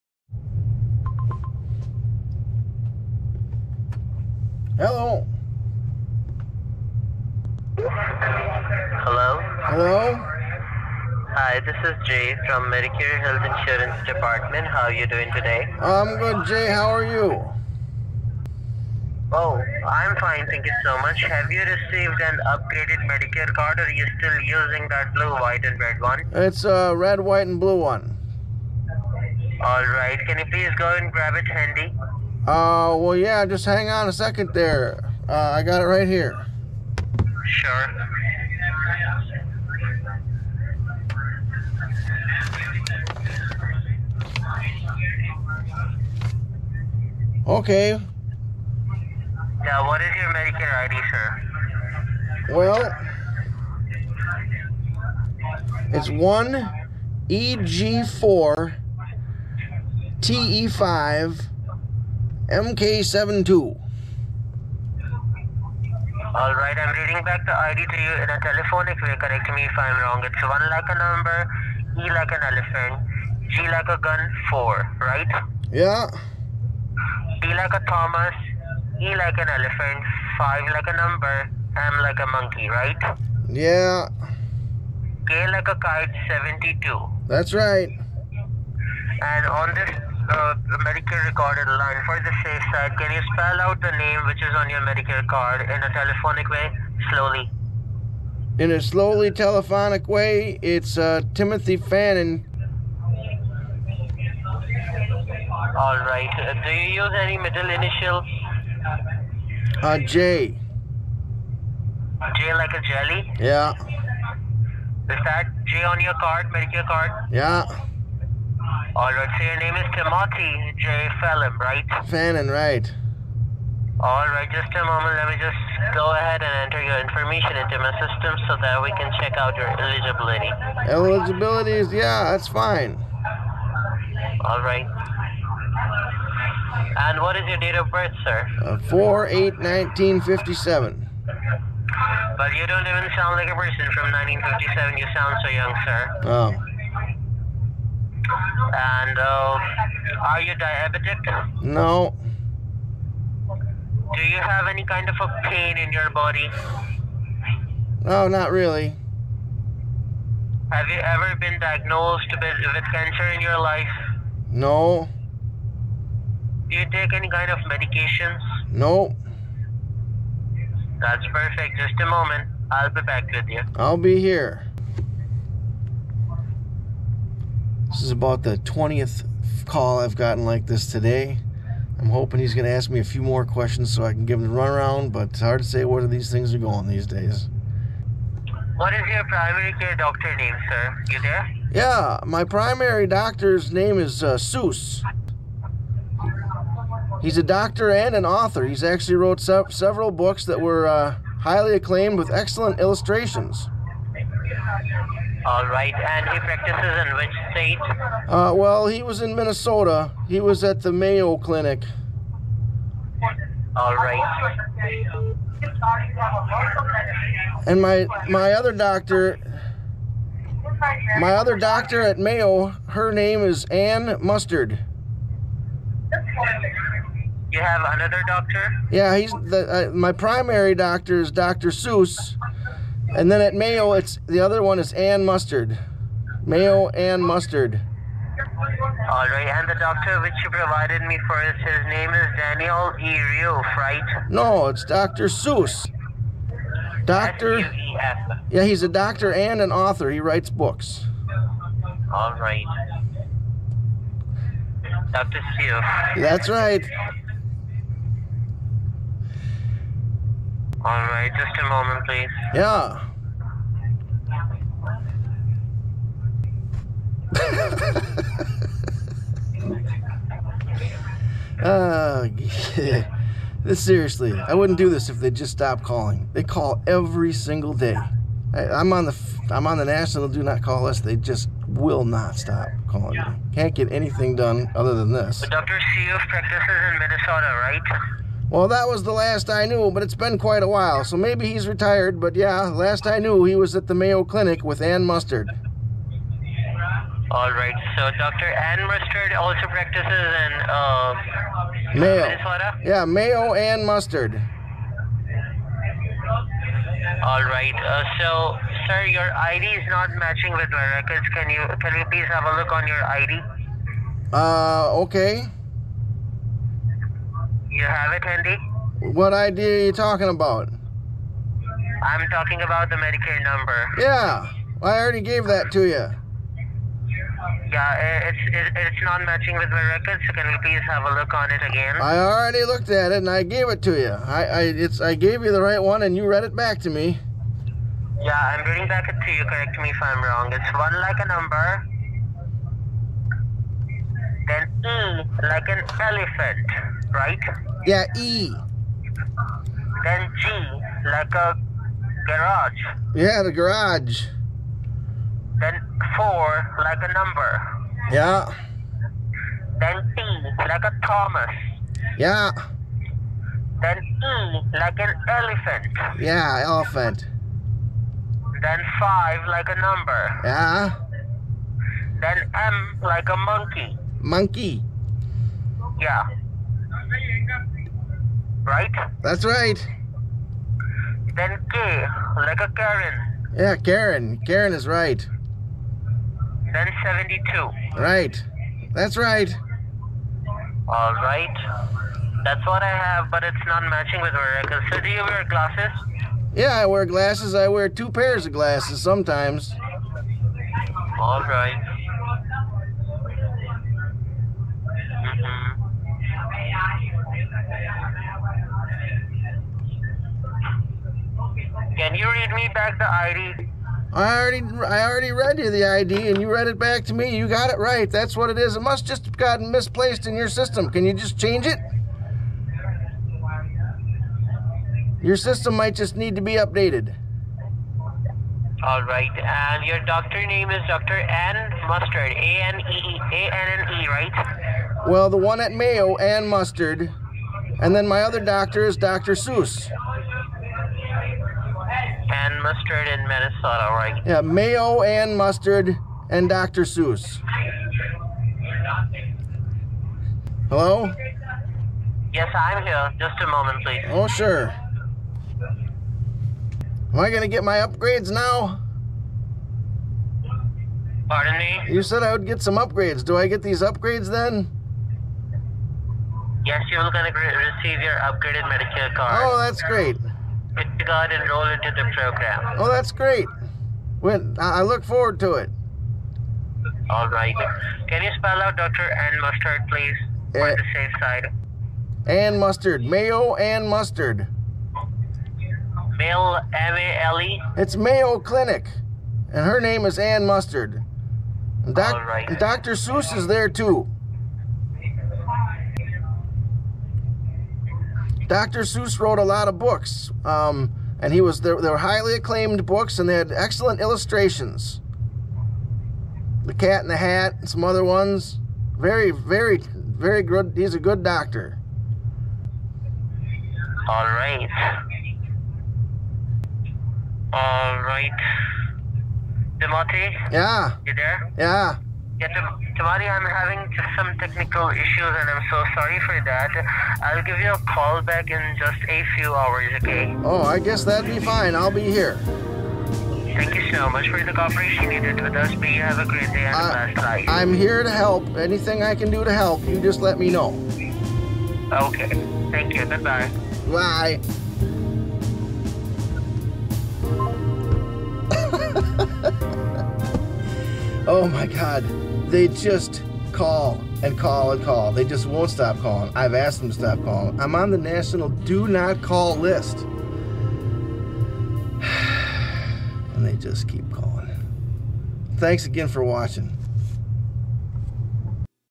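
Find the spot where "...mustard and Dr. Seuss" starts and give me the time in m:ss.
7:25.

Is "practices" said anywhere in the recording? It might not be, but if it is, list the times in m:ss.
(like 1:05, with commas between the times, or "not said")
3:26, 4:46, 4:59.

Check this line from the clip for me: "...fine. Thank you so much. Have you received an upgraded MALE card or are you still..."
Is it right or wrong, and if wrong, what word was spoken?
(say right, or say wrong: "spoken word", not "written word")
wrong: "Medicare", not "MALE".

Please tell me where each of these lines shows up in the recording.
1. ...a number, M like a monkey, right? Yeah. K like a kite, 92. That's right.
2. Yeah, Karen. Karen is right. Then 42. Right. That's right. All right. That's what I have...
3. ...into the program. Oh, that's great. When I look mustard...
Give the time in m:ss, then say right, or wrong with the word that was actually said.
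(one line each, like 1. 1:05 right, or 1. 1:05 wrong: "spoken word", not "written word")
1. 1:20 wrong: "72", not "92"
2. 6:23 wrong: "72", not "42"
3. 7:51 wrong: "forward", not "mustard".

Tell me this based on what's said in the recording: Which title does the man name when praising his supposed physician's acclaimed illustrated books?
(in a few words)
The Cat in the Hat.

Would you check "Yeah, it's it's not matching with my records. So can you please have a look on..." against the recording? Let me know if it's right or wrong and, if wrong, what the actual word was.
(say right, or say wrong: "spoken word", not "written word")
right.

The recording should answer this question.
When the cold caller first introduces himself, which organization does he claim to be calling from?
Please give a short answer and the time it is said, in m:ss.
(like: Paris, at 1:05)
Medicare Health Insurance Department, at 0:12.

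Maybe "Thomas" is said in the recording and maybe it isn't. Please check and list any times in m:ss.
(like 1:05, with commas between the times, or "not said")
1:17, 6:01.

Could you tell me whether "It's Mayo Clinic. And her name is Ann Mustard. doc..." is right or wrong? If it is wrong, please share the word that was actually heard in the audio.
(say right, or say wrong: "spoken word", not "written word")
right.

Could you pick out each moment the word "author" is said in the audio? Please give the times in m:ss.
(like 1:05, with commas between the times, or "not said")
3:18, 4:09.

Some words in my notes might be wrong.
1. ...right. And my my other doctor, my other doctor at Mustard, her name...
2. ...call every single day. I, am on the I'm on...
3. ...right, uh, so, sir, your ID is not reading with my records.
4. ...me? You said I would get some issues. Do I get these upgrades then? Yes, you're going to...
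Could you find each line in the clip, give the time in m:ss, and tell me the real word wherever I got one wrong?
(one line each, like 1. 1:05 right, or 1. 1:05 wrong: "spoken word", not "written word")
1. 3:33 wrong: "Mayo", not "Mustard"
2. 4:36 right
3. 5:07 wrong: "matching", not "reading"
4. 7:41 wrong: "upgrades", not "issues".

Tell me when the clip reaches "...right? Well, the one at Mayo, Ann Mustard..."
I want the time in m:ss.
7:14.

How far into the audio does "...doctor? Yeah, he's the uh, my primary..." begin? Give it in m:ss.
3:48.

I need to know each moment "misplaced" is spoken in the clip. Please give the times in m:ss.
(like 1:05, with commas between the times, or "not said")
6:59.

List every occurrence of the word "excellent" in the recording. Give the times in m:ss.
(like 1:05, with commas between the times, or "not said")
3:22, 8:23.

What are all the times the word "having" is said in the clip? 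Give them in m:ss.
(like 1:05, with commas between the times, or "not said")
8:43.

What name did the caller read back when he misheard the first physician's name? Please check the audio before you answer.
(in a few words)
Daniel E.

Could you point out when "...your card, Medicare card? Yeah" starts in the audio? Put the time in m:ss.
1:56.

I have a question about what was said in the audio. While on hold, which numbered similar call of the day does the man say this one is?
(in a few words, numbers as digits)
20th.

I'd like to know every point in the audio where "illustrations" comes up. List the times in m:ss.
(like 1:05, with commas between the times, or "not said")
3:22, 8:24.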